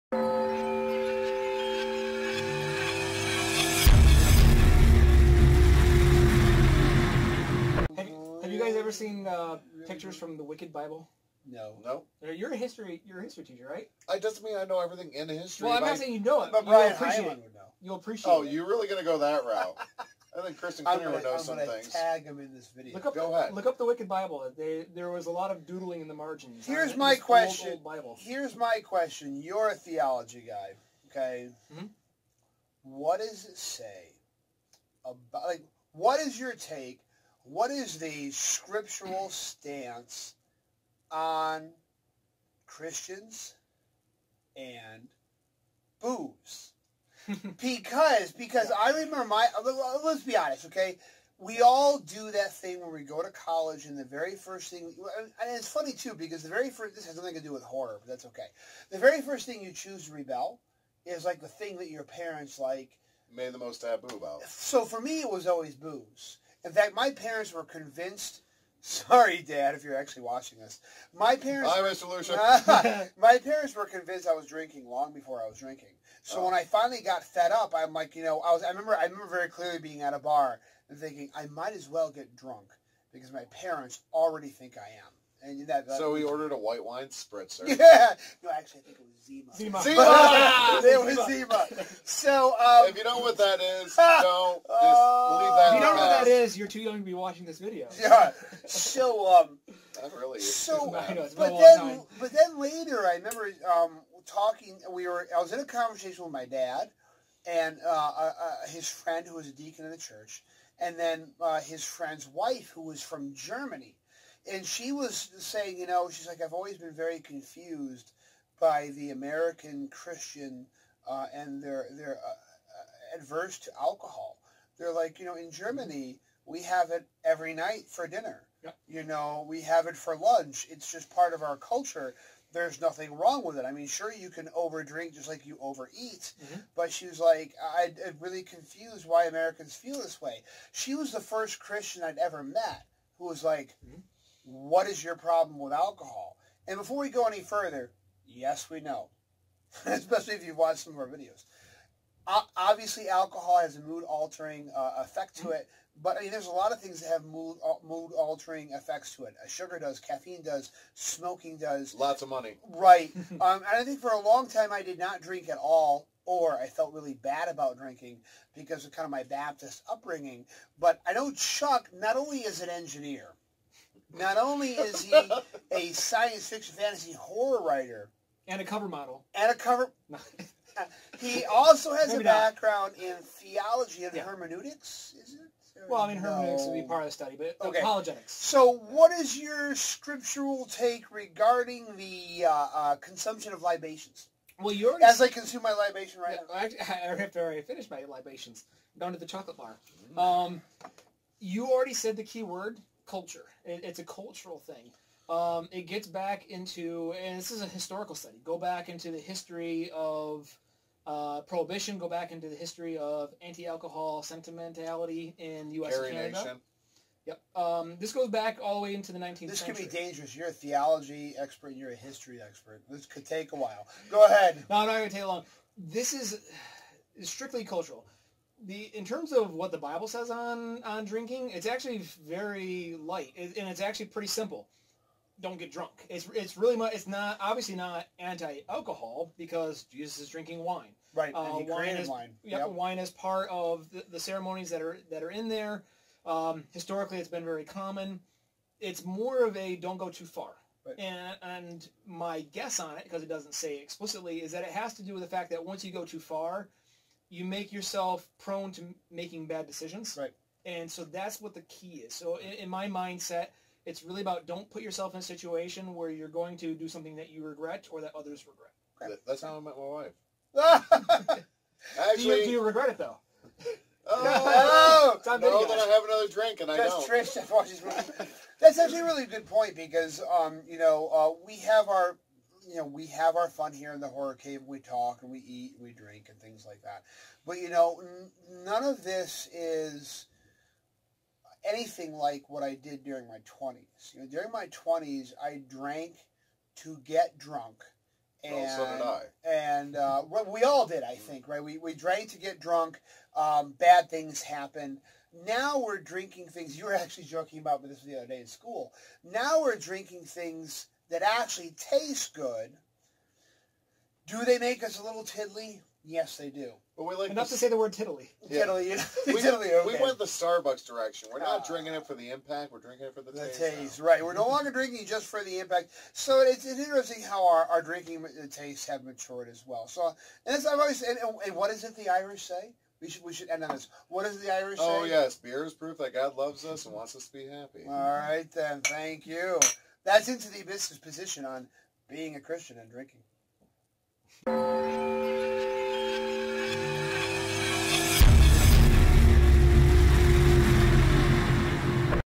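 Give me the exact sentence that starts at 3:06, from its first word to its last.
would be part of the study, but okay.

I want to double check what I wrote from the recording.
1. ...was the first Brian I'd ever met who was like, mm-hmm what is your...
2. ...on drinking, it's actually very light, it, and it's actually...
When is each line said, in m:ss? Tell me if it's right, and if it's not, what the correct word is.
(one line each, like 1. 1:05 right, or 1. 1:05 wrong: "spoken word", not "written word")
1. 2:20 wrong: "Christian", not "Brian"
2. 3:50 right.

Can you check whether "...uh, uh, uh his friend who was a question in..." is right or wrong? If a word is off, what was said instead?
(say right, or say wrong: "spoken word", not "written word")
wrong: "deacon", not "question".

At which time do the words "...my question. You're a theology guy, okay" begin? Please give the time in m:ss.
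0:28.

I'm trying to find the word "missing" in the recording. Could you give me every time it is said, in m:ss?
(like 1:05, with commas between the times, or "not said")
not said.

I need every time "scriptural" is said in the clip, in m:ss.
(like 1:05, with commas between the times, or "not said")
0:38, 3:09.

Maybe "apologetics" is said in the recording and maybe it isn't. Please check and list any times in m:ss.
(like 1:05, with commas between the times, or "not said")
3:07.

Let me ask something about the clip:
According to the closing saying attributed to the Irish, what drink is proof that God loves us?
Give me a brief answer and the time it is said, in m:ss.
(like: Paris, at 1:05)
Beer, at 5:35.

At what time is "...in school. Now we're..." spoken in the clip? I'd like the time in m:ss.
5:08.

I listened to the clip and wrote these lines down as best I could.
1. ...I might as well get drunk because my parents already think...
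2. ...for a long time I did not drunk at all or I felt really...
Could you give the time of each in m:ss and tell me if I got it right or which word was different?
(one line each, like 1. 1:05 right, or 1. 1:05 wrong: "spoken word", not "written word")
1. 1:21 right
2. 2:43 wrong: "drink", not "drunk".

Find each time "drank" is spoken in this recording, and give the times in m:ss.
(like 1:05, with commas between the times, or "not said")
4:55, 5:01.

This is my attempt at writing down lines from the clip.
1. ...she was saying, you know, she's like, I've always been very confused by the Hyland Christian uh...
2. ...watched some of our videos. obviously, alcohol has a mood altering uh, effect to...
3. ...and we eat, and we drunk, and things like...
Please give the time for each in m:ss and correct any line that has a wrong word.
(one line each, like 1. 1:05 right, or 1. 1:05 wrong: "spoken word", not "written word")
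1. 1:54 wrong: "American", not "Hyland"
2. 2:30 right
3. 4:45 wrong: "drink", not "drunk".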